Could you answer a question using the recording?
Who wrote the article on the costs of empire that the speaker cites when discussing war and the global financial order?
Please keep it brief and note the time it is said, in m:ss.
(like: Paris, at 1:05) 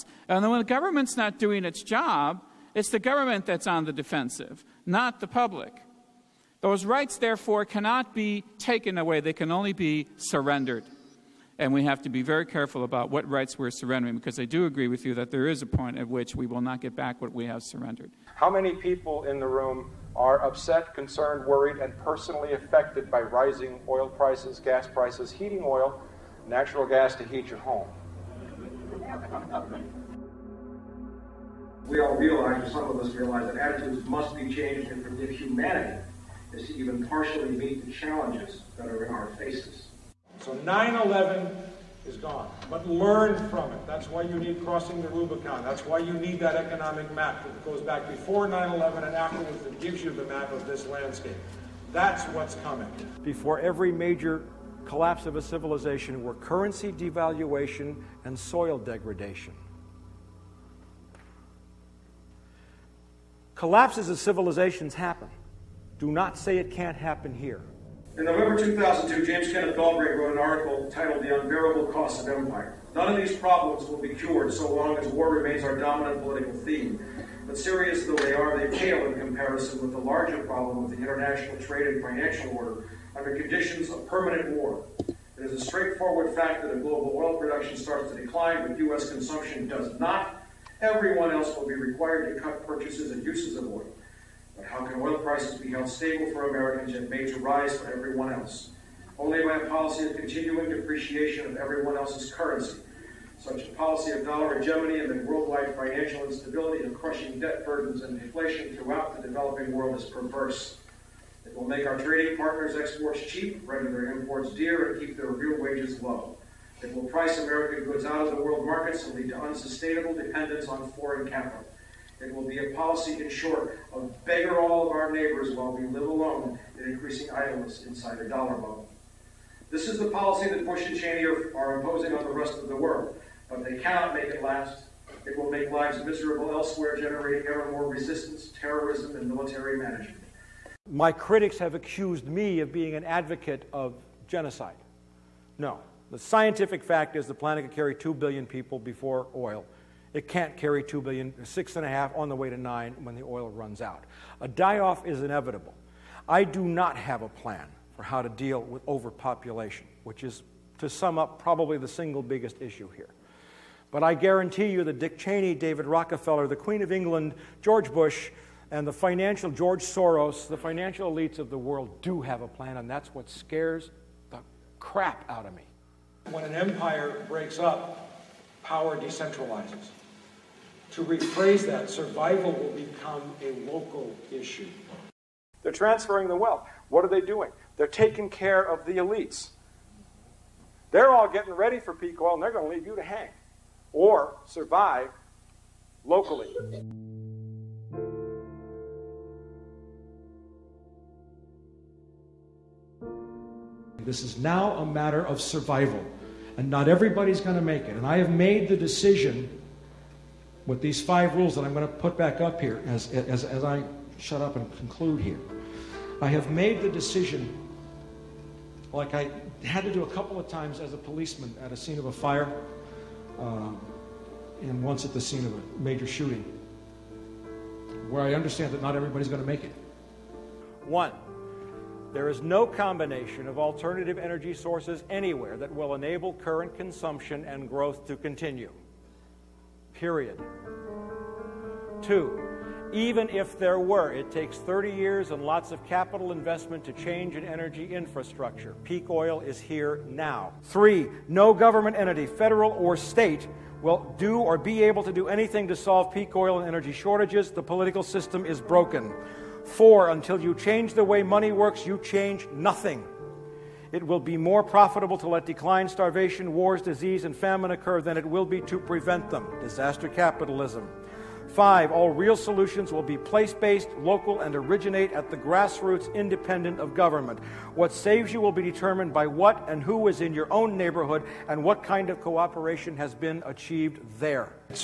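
James Kenneth Galbraith, at 1:09.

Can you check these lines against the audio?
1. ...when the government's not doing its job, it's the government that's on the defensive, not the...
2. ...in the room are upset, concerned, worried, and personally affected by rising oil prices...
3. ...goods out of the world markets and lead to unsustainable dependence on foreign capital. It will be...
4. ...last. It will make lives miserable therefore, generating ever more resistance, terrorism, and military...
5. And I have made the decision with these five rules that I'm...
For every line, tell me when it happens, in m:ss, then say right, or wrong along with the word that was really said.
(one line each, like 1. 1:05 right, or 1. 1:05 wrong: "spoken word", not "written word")
1. 0:00 right
2. 0:19 right
3. 1:57 right
4. 2:14 wrong: "elsewhere", not "therefore"
5. 3:27 right.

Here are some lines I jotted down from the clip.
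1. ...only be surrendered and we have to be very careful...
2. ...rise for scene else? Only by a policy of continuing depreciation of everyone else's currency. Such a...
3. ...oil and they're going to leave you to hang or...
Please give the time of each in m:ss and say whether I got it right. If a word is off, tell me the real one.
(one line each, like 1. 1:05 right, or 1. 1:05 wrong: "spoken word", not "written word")
1. 0:09 right
2. 1:37 wrong: "everyone", not "scene"
3. 3:12 right.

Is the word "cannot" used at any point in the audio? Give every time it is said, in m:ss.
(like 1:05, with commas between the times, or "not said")
0:07, 2:13.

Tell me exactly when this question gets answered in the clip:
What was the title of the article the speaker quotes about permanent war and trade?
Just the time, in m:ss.
1:11.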